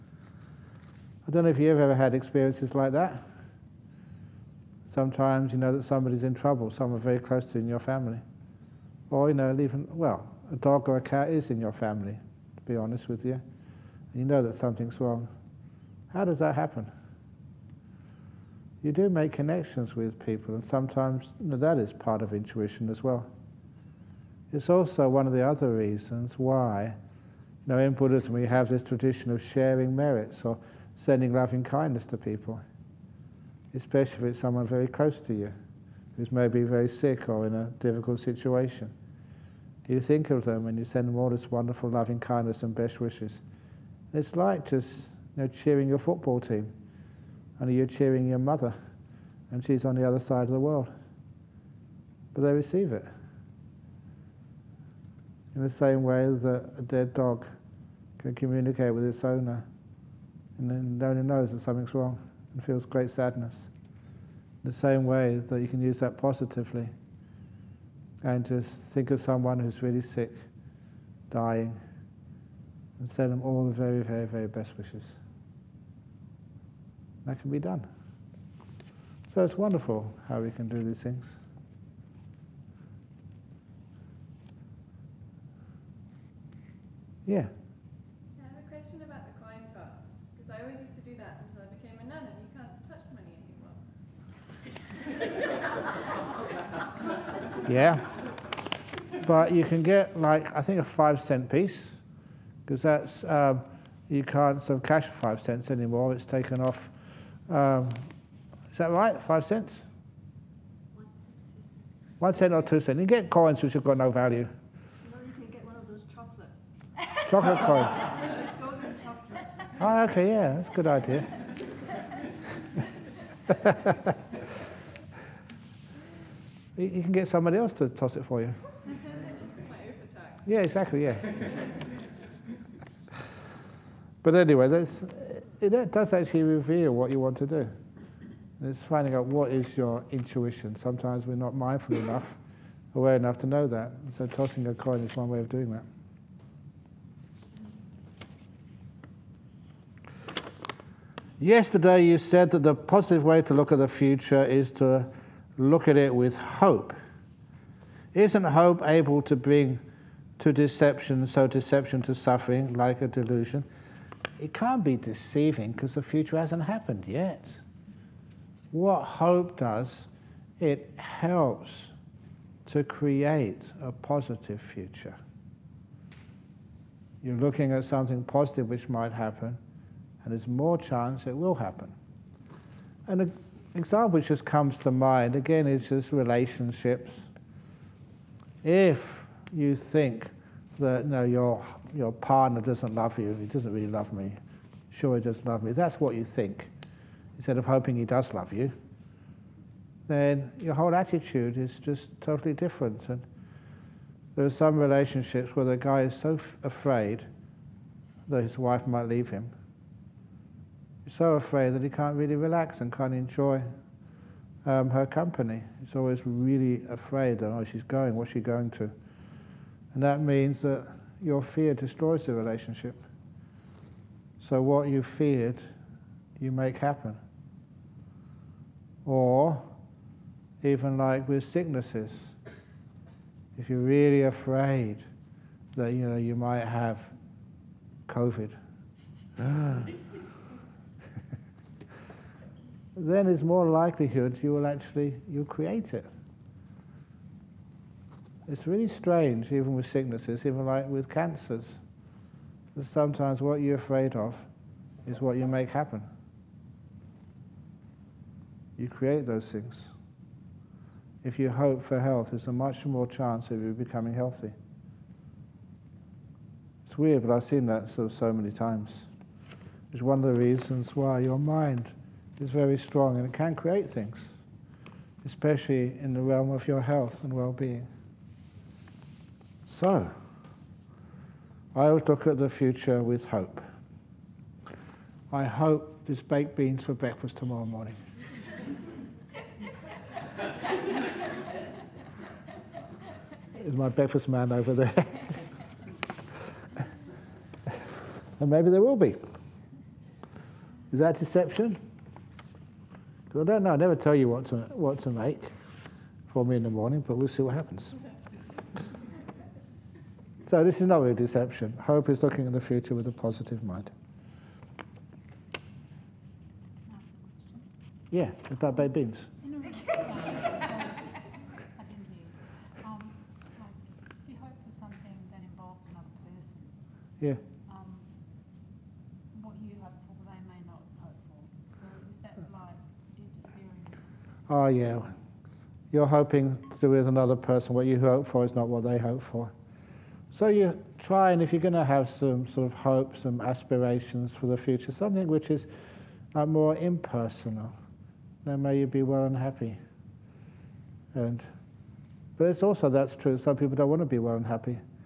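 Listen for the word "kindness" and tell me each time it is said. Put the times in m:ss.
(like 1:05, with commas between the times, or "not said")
0:31, 0:42.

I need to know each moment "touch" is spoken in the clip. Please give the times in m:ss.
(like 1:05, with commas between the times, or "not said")
1:37.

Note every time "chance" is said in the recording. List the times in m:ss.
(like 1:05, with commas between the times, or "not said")
3:00, 4:23.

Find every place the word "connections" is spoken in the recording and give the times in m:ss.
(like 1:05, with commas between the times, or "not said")
0:19.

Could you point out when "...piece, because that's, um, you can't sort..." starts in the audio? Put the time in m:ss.
1:41.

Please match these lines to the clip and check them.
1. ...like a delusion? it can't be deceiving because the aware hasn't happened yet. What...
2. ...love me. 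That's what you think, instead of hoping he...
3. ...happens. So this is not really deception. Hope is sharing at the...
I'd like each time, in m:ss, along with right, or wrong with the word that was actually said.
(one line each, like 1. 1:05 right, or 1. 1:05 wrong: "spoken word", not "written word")
1. 2:42 wrong: "future", not "aware"
2. 3:15 right
3. 5:07 wrong: "looking", not "sharing".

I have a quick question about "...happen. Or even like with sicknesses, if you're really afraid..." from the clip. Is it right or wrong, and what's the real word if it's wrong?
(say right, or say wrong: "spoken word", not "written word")
right.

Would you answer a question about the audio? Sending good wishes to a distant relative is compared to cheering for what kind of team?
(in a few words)
football team.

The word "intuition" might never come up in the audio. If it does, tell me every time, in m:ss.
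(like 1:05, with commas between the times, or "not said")
0:22, 2:20.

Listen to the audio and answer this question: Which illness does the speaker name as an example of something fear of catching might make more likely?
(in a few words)
COVID.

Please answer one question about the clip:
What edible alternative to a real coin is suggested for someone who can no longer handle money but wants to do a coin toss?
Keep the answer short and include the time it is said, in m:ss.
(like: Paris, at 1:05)
chocolate coins, at 1:57.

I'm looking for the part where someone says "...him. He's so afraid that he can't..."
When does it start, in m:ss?
3:29.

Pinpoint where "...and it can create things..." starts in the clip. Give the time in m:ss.
4:33.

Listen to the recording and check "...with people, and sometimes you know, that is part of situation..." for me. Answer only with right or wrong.
wrong.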